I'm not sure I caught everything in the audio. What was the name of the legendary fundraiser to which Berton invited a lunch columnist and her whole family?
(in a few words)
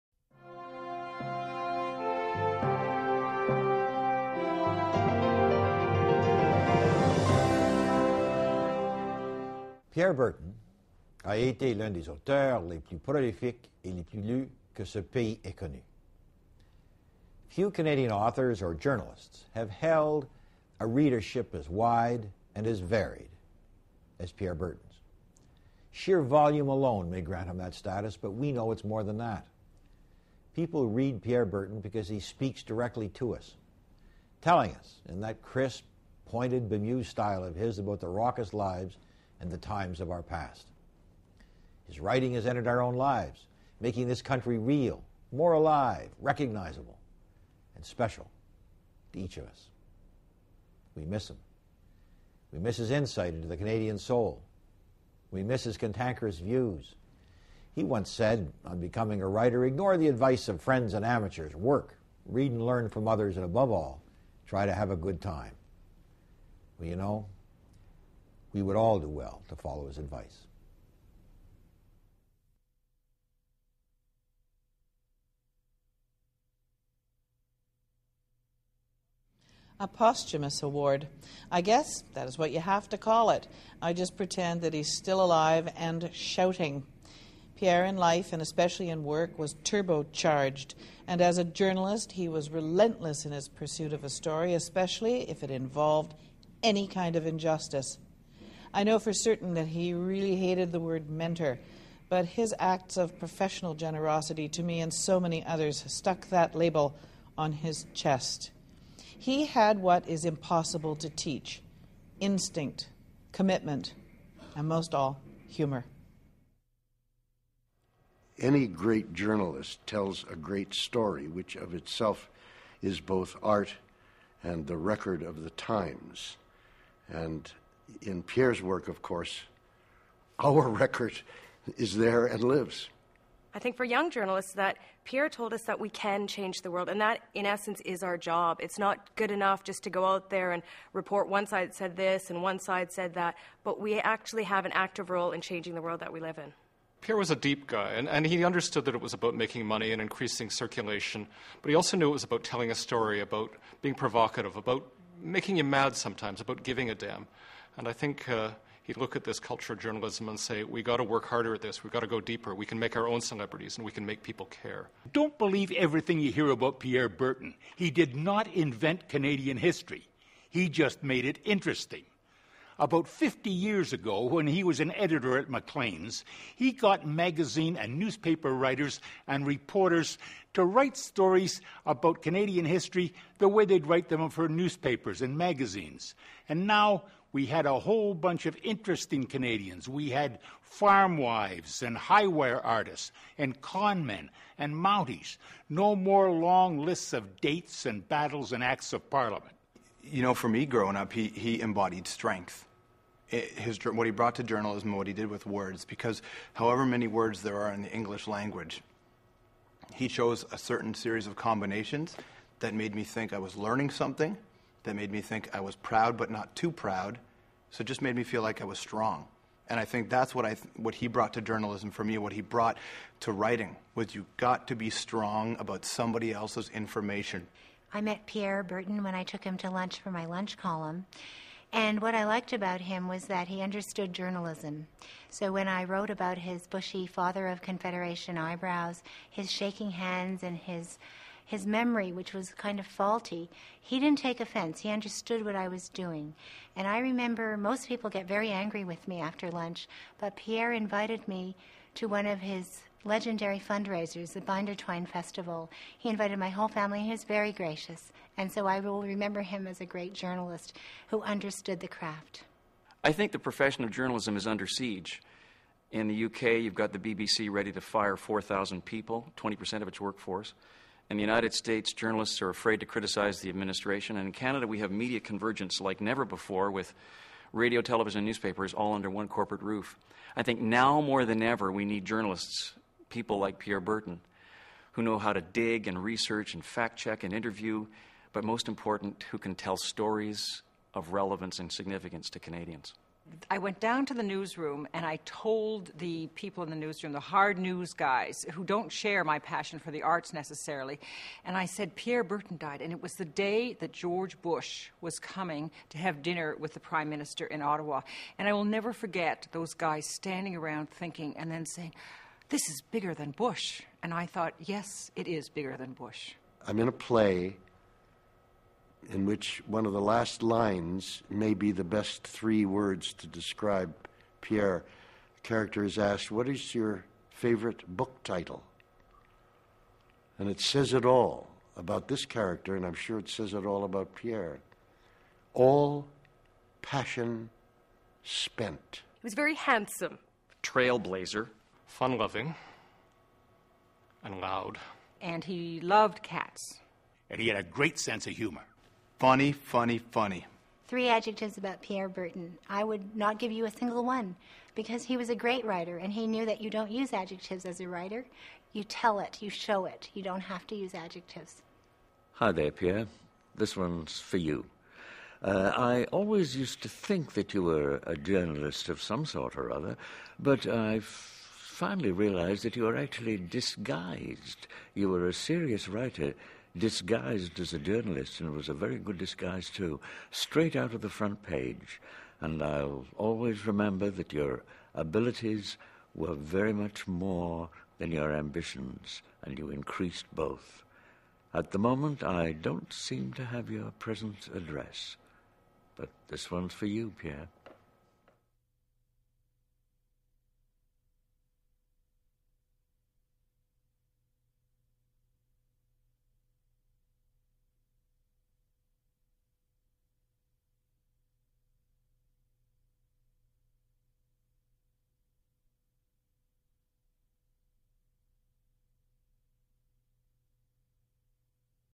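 Binder Twine Festival.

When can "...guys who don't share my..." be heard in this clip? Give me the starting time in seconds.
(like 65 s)
297 s.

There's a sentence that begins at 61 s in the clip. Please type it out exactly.
Work, read and learn from others, and above all, try to have a good time.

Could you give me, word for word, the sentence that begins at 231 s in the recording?
And what I liked about him was that he understood journalism.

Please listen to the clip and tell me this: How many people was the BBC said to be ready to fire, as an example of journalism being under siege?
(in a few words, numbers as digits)
4,000.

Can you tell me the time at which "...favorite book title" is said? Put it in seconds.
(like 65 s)
327 s.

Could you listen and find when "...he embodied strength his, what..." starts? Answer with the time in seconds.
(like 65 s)
201 s.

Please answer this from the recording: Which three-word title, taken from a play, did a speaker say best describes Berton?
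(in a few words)
All passion spent.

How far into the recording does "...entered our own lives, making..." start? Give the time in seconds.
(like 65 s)
42 s.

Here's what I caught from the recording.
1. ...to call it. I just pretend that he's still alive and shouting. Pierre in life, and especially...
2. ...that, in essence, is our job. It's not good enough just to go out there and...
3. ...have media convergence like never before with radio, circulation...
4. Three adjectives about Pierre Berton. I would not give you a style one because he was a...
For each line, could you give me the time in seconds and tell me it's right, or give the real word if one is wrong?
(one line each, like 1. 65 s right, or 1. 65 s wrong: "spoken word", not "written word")
1. 82 s right
2. 137 s right
3. 274 s wrong: "television", not "circulation"
4. 350 s wrong: "single", not "style".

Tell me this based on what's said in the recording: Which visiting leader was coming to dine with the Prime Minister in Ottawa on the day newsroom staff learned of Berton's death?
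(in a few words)
George Bush.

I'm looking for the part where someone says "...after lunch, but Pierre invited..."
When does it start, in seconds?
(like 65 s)
249 s.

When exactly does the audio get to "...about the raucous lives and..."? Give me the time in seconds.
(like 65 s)
37 s.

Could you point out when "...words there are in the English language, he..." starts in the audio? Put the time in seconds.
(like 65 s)
207 s.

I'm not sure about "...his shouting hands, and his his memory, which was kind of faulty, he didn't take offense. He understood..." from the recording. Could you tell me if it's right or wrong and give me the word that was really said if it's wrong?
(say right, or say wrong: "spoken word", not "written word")
wrong: "shaking", not "shouting".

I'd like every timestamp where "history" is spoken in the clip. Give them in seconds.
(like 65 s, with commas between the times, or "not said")
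169 s, 182 s.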